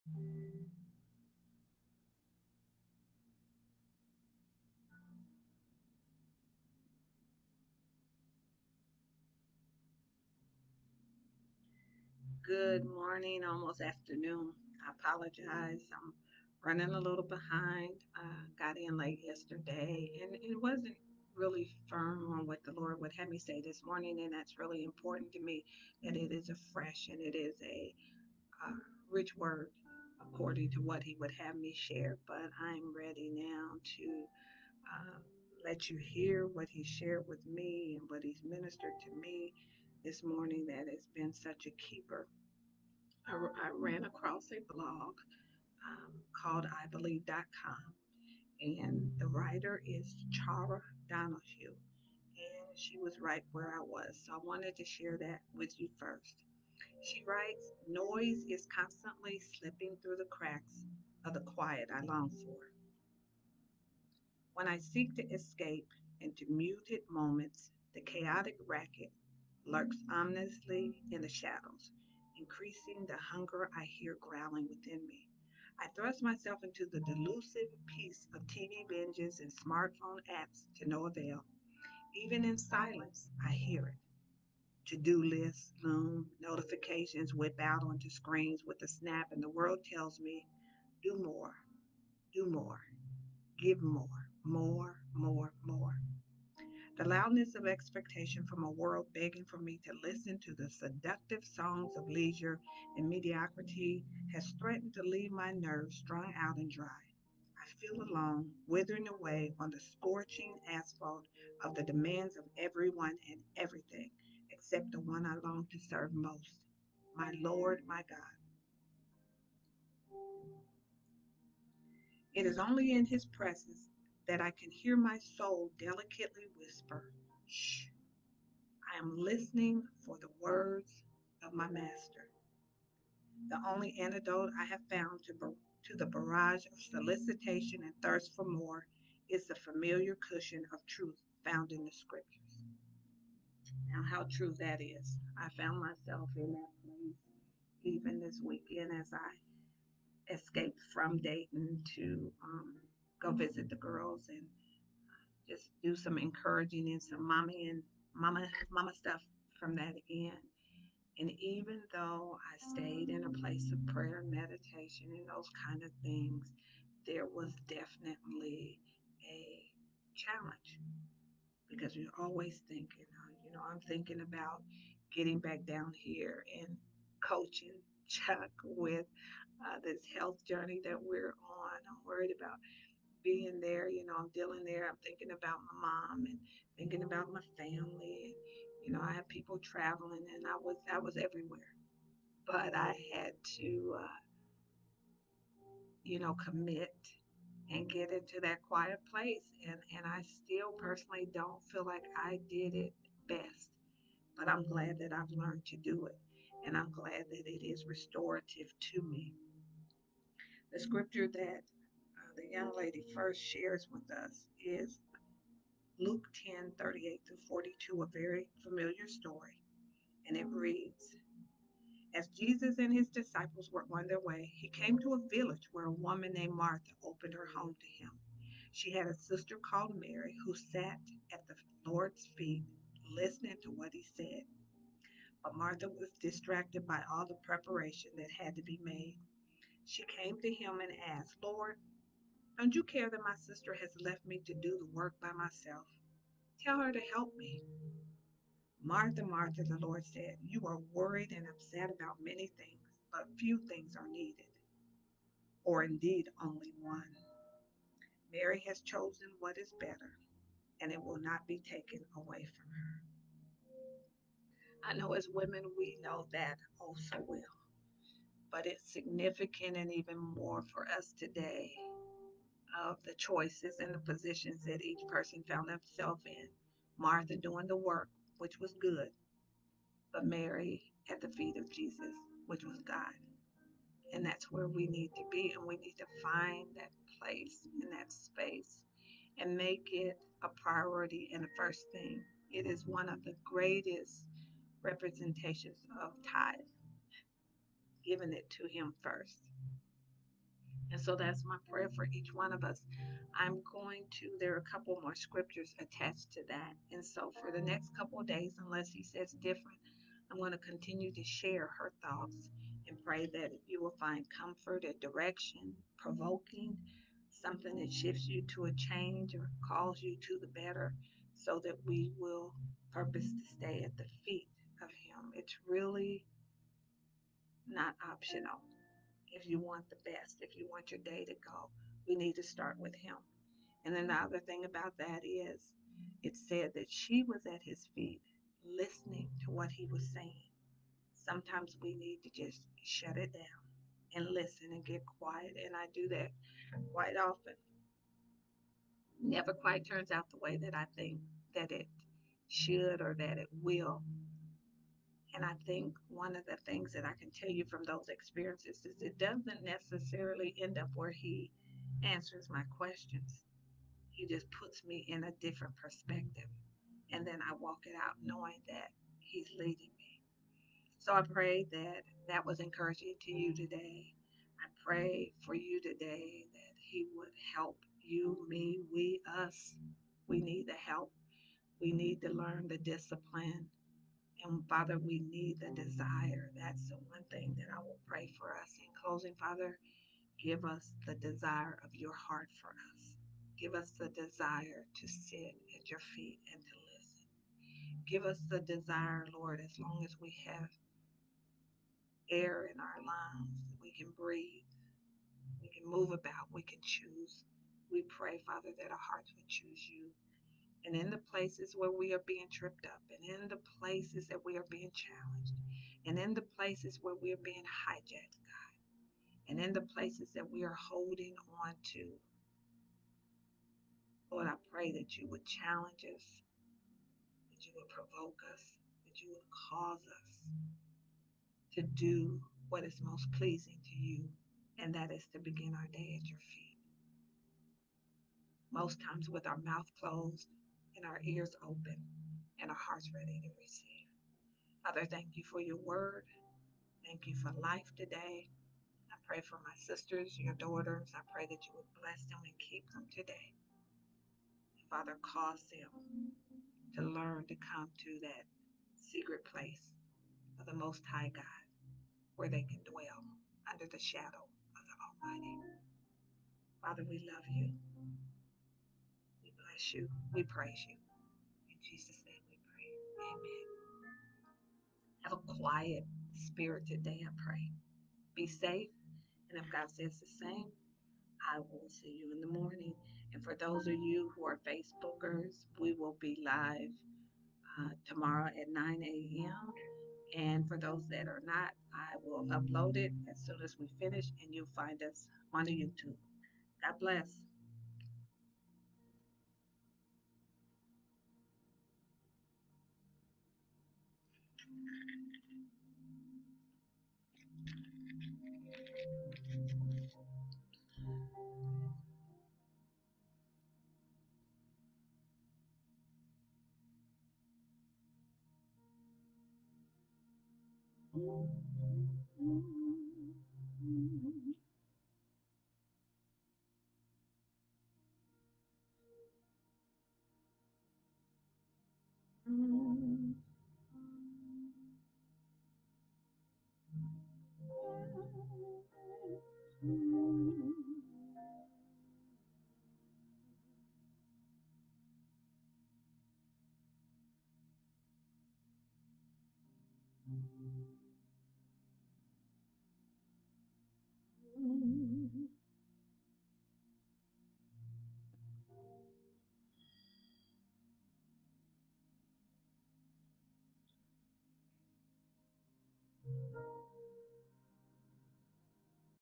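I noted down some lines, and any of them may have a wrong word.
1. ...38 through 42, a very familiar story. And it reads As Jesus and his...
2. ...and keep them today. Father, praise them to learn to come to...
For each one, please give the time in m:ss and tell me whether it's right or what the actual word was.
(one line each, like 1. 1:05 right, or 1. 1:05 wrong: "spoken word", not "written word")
1. 3:36 right
2. 7:32 wrong: "cause", not "praise".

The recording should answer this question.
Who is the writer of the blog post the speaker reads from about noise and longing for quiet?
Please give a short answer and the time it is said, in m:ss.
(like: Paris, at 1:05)
Chara Donahue, at 0:50.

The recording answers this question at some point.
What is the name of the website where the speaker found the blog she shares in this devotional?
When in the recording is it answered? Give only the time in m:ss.
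0:46.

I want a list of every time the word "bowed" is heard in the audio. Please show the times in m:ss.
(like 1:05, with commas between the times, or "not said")
not said.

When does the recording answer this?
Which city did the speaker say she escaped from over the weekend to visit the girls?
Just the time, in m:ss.
2:31.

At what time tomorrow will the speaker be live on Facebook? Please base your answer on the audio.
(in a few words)
9 a.m.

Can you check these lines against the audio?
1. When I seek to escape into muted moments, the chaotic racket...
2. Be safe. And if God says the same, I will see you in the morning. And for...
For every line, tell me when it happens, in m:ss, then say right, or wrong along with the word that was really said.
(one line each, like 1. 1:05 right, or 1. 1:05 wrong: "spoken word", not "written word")
1. 1:04 right
2. 7:58 right.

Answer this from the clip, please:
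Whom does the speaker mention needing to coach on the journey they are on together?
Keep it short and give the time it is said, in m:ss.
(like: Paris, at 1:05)
Chuck, at 2:58.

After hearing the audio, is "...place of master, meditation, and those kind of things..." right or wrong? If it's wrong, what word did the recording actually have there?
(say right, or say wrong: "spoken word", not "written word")
wrong: "prayer", not "master".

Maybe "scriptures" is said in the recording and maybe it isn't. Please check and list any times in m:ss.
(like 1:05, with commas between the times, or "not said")
2:21, 3:30, 5:05.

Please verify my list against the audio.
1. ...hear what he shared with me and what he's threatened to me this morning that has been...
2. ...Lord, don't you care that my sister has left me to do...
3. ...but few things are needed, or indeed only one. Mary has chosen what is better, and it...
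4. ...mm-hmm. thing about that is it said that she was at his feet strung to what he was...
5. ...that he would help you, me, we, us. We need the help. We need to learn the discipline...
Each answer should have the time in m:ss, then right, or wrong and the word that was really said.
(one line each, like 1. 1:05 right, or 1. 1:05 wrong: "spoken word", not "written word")
1. 0:36 wrong: "ministered", not "threatened"
2. 4:01 right
3. 4:13 right
4. 5:34 wrong: "listening", not "strung"
5. 6:16 right.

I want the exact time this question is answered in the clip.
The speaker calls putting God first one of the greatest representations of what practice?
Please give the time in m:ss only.
4:56.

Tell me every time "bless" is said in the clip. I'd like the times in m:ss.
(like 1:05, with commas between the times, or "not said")
7:31, 7:49, 8:16.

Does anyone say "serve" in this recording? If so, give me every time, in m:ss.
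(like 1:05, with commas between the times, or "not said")
1:55.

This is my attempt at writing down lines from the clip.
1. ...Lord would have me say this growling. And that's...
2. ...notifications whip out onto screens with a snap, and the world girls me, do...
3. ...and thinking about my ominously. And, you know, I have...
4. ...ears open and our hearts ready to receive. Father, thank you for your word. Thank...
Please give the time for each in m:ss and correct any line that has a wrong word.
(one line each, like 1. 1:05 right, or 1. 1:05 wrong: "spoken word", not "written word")
1. 0:22 wrong: "morning", not "growling"
2. 1:26 wrong: "tells", not "girls"
3. 3:06 wrong: "family", not "ominously"
4. 7:21 right.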